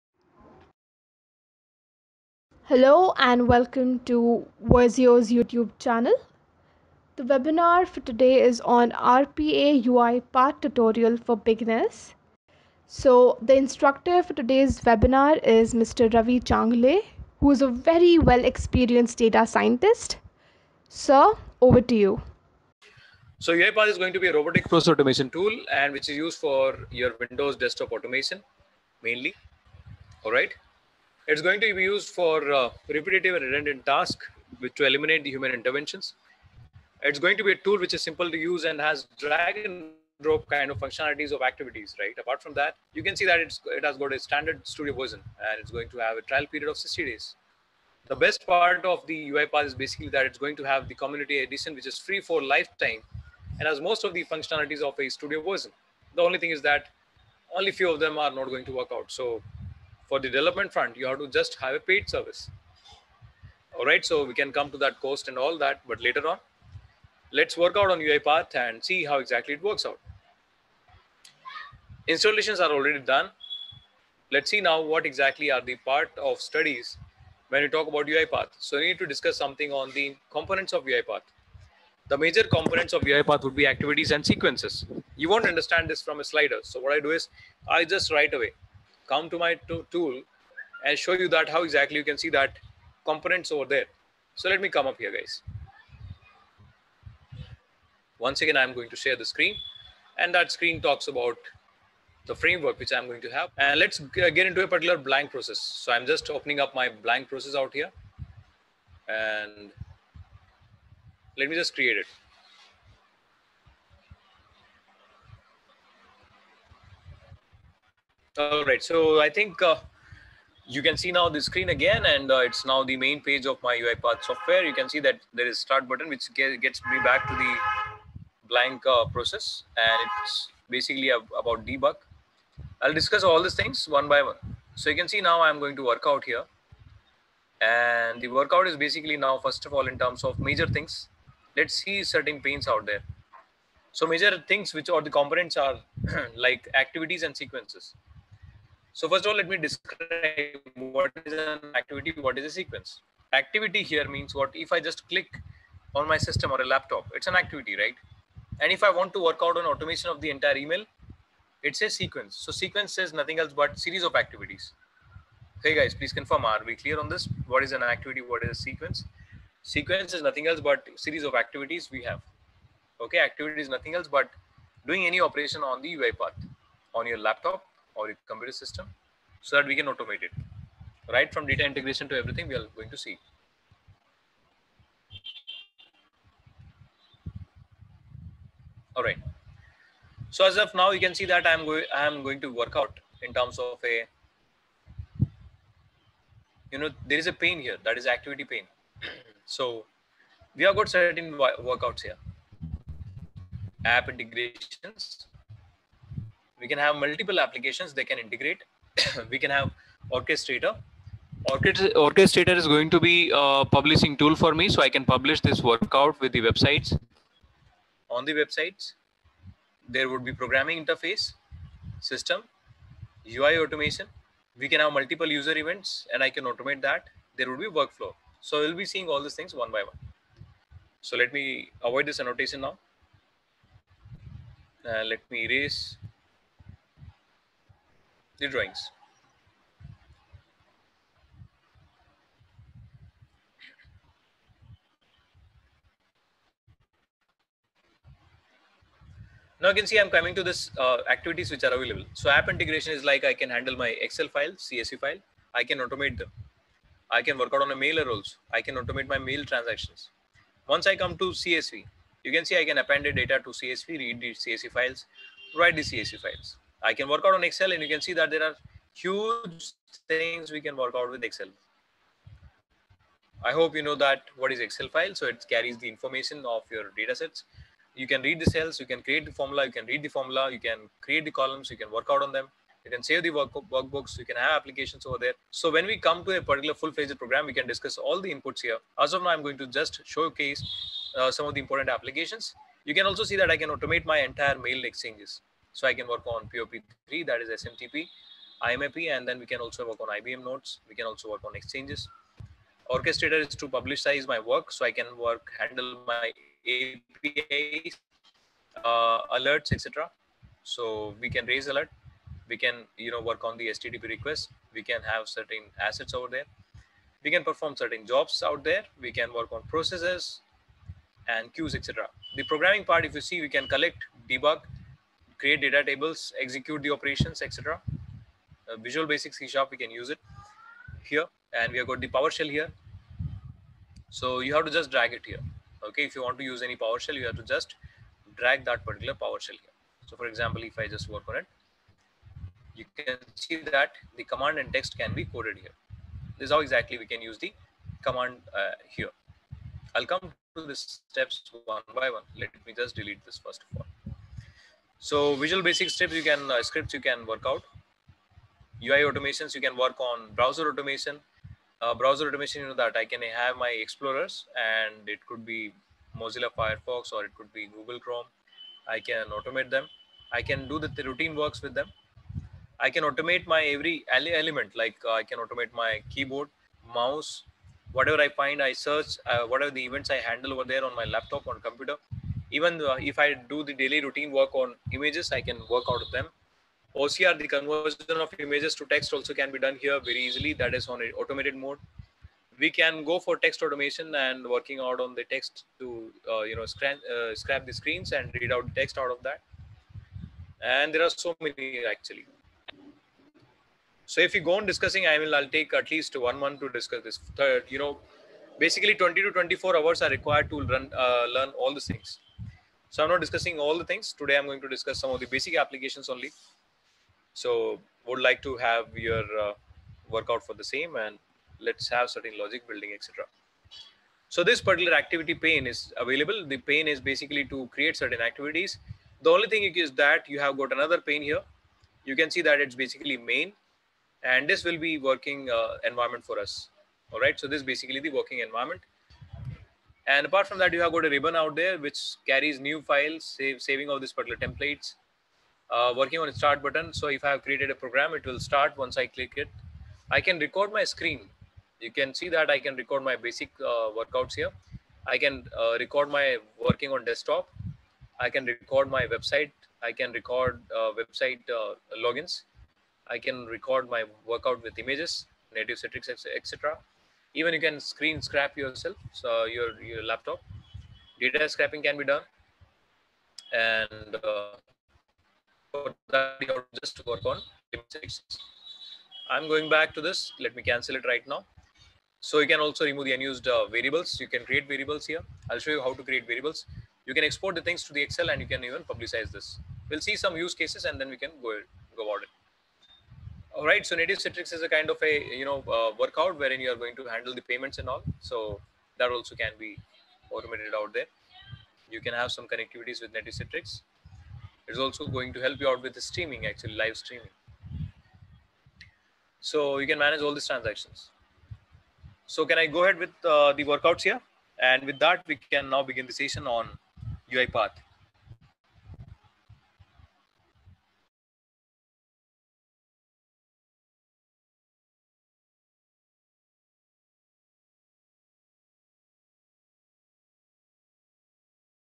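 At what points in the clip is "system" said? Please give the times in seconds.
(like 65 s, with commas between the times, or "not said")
156 s, 178 s, 222 s.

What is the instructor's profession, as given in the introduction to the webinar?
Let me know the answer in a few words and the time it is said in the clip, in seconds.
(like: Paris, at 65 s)
Data scientist, at 19 s.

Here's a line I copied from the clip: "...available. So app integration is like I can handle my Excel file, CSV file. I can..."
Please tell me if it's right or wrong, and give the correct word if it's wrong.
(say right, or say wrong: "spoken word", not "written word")
right.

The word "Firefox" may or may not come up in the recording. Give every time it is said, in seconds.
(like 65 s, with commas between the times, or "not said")
366 s.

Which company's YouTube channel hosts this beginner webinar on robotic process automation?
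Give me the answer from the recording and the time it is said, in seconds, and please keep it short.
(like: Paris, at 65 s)
Verzeo, at 4 s.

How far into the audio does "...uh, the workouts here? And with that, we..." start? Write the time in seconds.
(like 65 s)
513 s.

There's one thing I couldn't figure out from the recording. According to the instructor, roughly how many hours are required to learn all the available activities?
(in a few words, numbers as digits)
20 to 24 hours.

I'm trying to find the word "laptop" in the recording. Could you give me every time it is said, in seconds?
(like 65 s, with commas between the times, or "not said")
156 s, 177 s, 381 s, 470 s.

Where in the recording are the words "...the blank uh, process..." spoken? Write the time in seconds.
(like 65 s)
127 s.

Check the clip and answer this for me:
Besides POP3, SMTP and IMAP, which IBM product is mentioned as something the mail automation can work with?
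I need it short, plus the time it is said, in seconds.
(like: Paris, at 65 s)
IBM Notes, at 300 s.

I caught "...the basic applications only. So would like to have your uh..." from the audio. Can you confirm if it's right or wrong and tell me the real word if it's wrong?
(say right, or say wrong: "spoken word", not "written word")
right.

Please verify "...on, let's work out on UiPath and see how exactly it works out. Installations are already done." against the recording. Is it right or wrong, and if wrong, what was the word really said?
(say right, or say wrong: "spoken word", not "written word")
right.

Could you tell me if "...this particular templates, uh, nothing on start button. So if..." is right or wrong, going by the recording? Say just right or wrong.
wrong.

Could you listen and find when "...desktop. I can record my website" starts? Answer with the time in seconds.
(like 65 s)
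457 s.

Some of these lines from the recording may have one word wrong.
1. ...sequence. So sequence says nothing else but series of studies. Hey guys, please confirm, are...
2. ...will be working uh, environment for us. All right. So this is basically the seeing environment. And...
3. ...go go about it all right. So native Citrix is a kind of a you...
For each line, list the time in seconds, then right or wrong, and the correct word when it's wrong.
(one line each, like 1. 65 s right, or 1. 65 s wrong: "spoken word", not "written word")
1. 161 s wrong: "activities", not "studies"
2. 434 s wrong: "working", not "seeing"
3. 491 s right.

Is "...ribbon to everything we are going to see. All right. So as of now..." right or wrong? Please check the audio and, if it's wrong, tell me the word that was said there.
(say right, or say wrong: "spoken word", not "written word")
wrong: "integration", not "ribbon".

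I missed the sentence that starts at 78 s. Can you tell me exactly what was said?
So we need to discuss something on the components of UiPath.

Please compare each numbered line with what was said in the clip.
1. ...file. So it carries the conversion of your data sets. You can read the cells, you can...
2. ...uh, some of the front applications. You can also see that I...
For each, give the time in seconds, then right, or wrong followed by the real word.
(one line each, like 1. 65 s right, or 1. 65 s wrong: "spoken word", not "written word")
1. 274 s wrong: "information", not "conversion"
2. 291 s wrong: "important", not "front".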